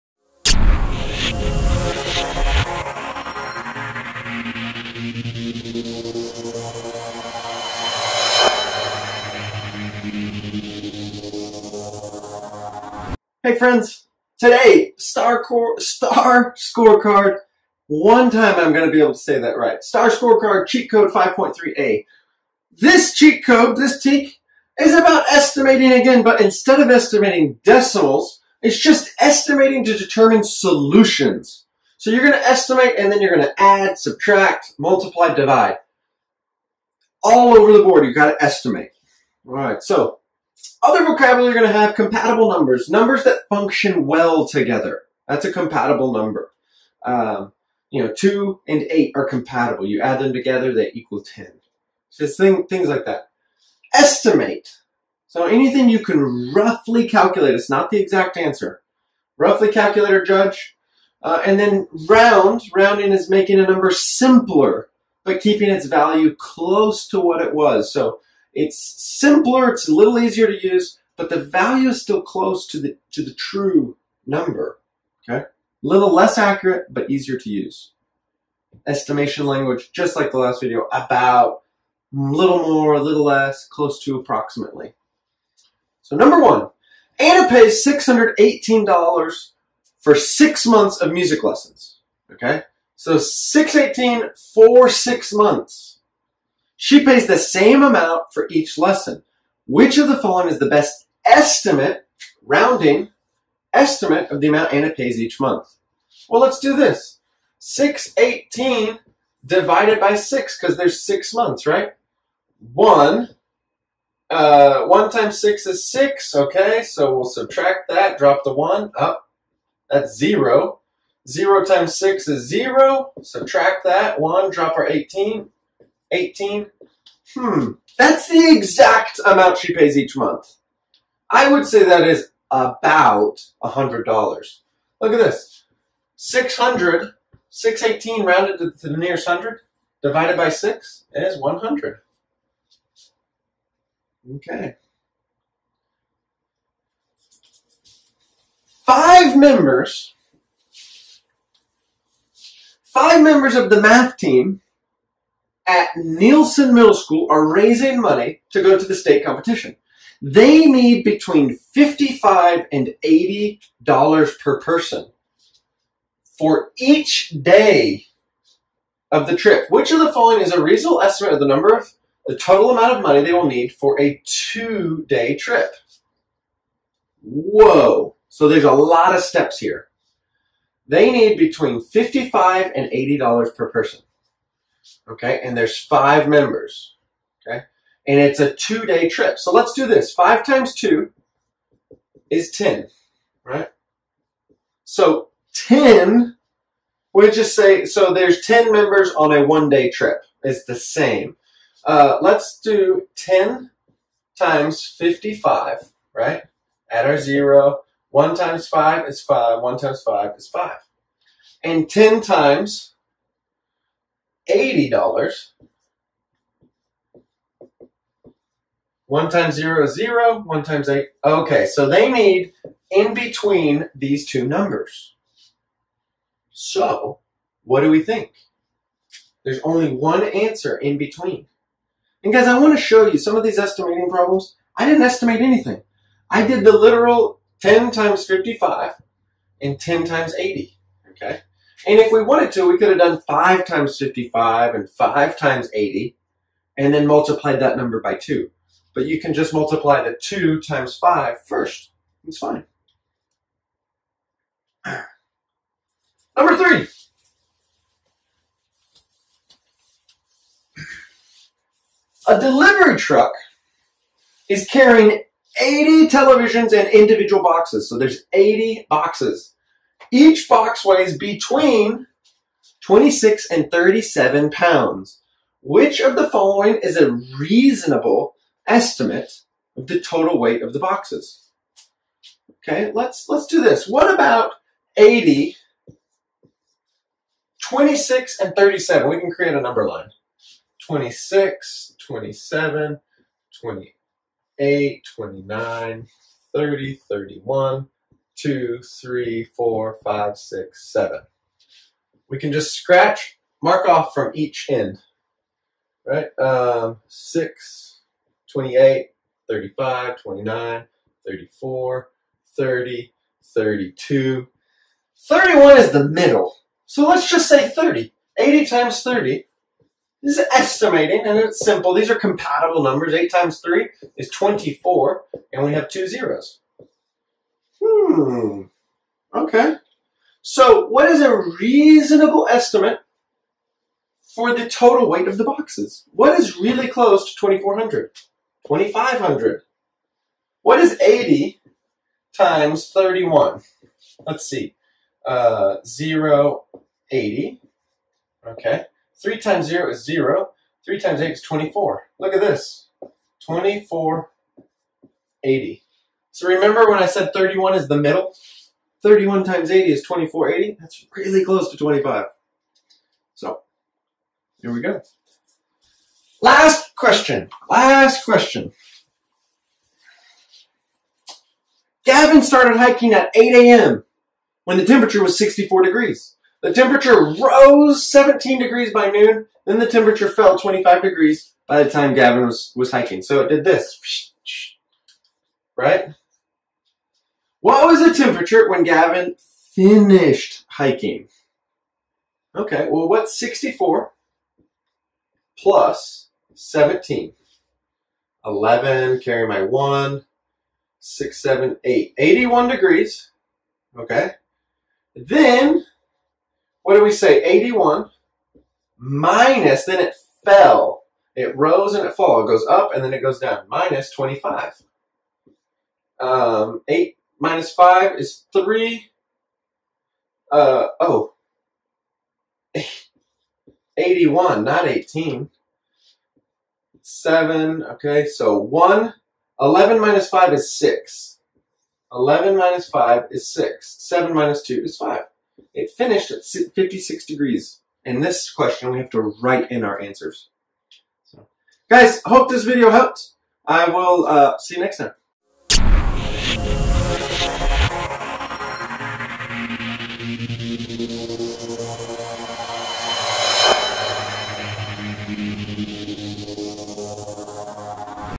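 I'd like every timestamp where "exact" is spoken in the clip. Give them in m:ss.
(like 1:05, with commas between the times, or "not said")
0:58, 2:08.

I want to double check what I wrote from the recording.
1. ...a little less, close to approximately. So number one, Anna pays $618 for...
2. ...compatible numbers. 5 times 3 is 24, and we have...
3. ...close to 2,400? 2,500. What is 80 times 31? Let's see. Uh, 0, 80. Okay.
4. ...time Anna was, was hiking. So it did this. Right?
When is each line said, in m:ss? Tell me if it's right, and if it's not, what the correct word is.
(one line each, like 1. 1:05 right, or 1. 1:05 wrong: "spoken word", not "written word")
1. 1:22 right
2. 5:22 wrong: "8", not "5"
3. 5:36 right
4. 6:21 wrong: "Gavin", not "Anna".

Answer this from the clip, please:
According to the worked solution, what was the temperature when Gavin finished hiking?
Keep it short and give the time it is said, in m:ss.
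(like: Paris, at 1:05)
56 degrees, at 7:16.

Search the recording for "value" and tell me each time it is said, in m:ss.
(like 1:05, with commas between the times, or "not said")
1:05, 1:11.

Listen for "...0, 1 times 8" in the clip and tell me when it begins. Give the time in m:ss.
3:39.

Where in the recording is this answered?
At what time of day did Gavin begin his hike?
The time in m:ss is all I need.
6:13.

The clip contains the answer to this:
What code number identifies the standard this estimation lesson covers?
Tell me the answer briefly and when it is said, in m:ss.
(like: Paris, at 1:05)
5.3a, at 0:21.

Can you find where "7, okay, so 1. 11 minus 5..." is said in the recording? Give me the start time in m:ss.
7:07.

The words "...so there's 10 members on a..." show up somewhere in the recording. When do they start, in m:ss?
3:17.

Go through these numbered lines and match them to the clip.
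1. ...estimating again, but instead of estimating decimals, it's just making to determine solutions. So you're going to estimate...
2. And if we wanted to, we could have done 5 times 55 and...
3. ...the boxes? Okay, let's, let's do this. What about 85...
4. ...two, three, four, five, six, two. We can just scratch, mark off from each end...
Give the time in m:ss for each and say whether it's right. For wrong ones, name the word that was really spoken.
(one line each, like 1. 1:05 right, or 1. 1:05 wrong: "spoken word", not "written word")
1. 0:25 wrong: "estimating", not "making"
2. 4:01 right
3. 4:40 wrong: "80", not "85"
4. 4:58 wrong: "seven", not "two".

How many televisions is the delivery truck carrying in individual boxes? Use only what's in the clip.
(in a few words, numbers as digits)
80.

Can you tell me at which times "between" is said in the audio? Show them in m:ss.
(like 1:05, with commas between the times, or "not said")
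2:41, 3:01, 3:43, 3:50, 4:31.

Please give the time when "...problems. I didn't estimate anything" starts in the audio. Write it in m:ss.
3:54.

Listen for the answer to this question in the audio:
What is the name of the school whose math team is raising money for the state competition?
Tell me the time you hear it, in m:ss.
2:35.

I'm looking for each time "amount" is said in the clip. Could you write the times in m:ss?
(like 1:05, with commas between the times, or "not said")
1:37, 1:44, 2:09, 2:52.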